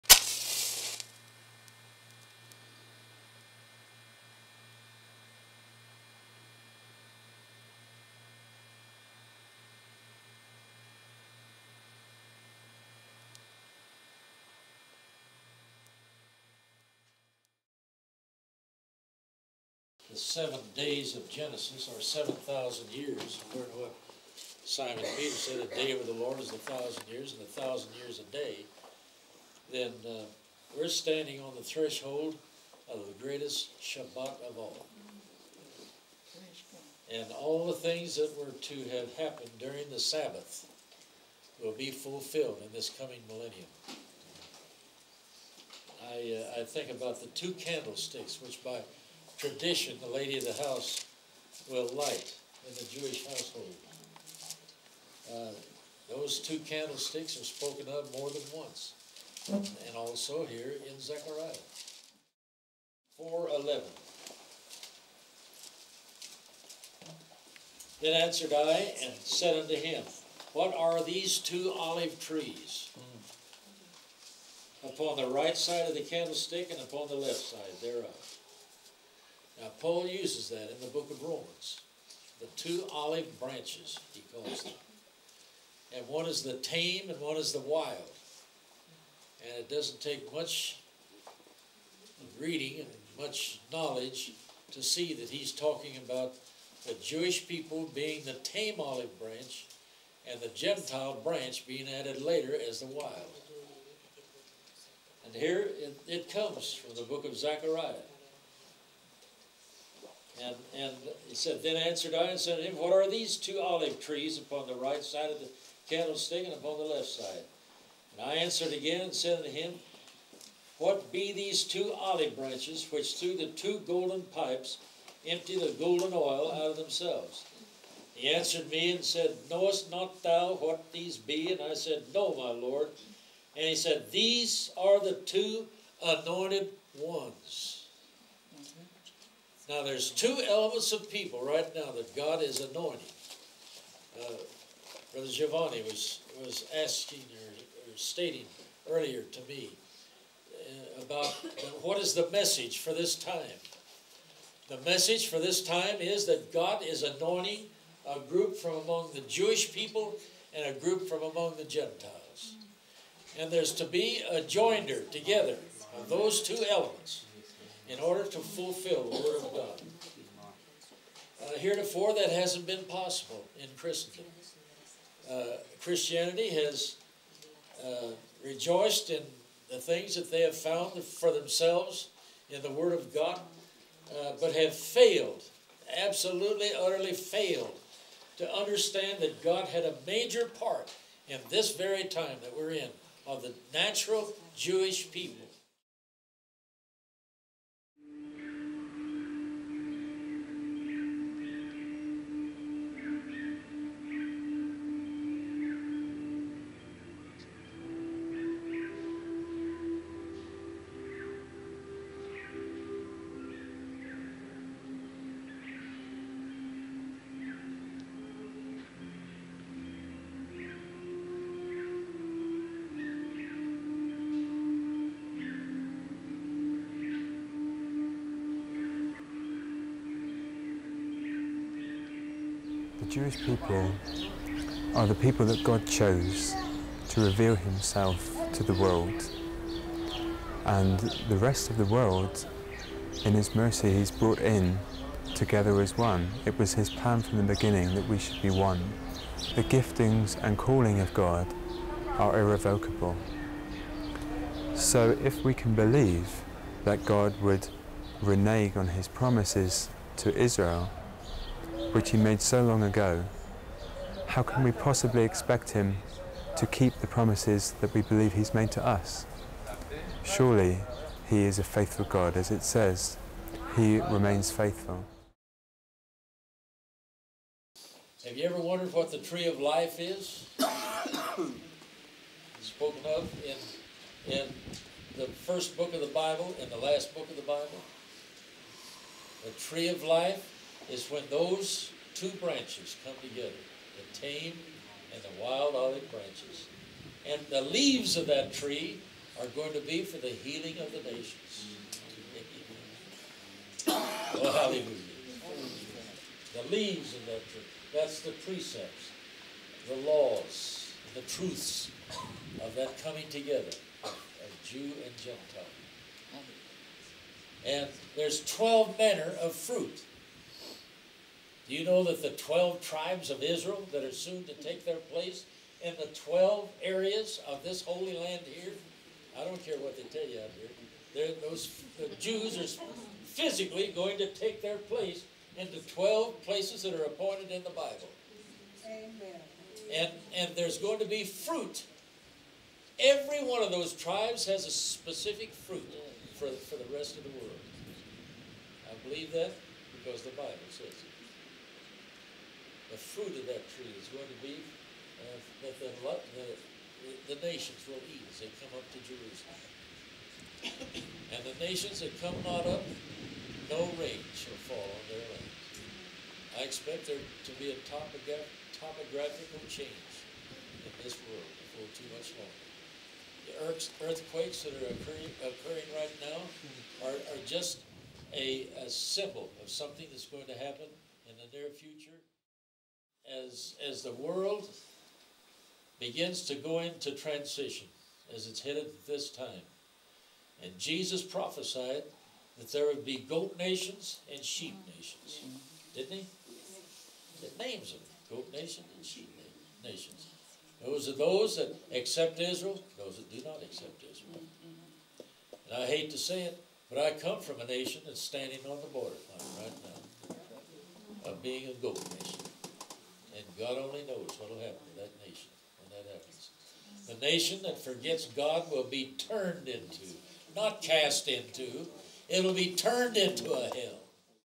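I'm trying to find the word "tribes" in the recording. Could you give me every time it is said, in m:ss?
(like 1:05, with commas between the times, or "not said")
5:22, 5:43.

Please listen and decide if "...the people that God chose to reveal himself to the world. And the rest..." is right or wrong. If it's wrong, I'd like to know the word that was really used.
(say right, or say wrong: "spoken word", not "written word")
right.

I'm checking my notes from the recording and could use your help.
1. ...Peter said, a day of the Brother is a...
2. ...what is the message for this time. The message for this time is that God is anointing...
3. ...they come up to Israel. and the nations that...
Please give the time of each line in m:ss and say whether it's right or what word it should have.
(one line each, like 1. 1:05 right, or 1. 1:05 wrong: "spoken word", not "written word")
1. 0:25 wrong: "Lord", not "Brother"
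2. 2:31 right
3. 5:58 wrong: "Jerusalem", not "Israel".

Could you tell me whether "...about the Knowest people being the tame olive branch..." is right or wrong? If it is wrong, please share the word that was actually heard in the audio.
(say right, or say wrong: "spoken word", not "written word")
wrong: "Jewish", not "Knowest".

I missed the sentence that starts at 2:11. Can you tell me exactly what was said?
And I said, No, my Lord.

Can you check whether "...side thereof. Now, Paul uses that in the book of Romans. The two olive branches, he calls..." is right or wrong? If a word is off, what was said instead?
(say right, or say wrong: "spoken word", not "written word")
right.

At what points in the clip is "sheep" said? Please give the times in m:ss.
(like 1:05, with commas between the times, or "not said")
6:34, 6:39.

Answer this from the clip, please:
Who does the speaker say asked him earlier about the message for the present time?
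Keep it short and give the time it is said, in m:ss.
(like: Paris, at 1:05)
Giovanni, at 2:25.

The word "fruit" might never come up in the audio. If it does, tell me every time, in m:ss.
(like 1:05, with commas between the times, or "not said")
5:19, 5:41, 5:45, 5:52.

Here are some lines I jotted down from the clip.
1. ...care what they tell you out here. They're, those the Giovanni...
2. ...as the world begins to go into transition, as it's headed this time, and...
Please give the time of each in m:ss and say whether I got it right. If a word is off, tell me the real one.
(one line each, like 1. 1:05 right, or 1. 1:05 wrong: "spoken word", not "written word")
1. 5:29 wrong: "Jews", not "Giovanni"
2. 6:23 right.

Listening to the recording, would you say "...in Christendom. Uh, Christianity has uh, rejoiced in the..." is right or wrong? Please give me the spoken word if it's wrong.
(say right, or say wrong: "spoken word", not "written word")
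right.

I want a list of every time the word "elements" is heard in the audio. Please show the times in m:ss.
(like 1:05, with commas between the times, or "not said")
2:20, 2:46.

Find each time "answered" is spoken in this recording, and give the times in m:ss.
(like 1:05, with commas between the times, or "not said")
1:08, 1:51, 1:58, 2:08.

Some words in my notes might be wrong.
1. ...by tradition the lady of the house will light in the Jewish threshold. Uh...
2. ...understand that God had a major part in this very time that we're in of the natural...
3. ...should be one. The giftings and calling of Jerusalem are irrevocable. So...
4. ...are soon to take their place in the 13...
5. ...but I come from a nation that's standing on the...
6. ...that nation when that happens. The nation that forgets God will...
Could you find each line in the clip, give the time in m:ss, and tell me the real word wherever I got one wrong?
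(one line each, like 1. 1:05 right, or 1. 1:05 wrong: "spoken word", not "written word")
1. 0:48 wrong: "household", not "threshold"
2. 3:08 right
3. 4:08 wrong: "God", not "Jerusalem"
4. 5:24 wrong: "12", not "13"
5. 6:46 right
6. 6:55 right.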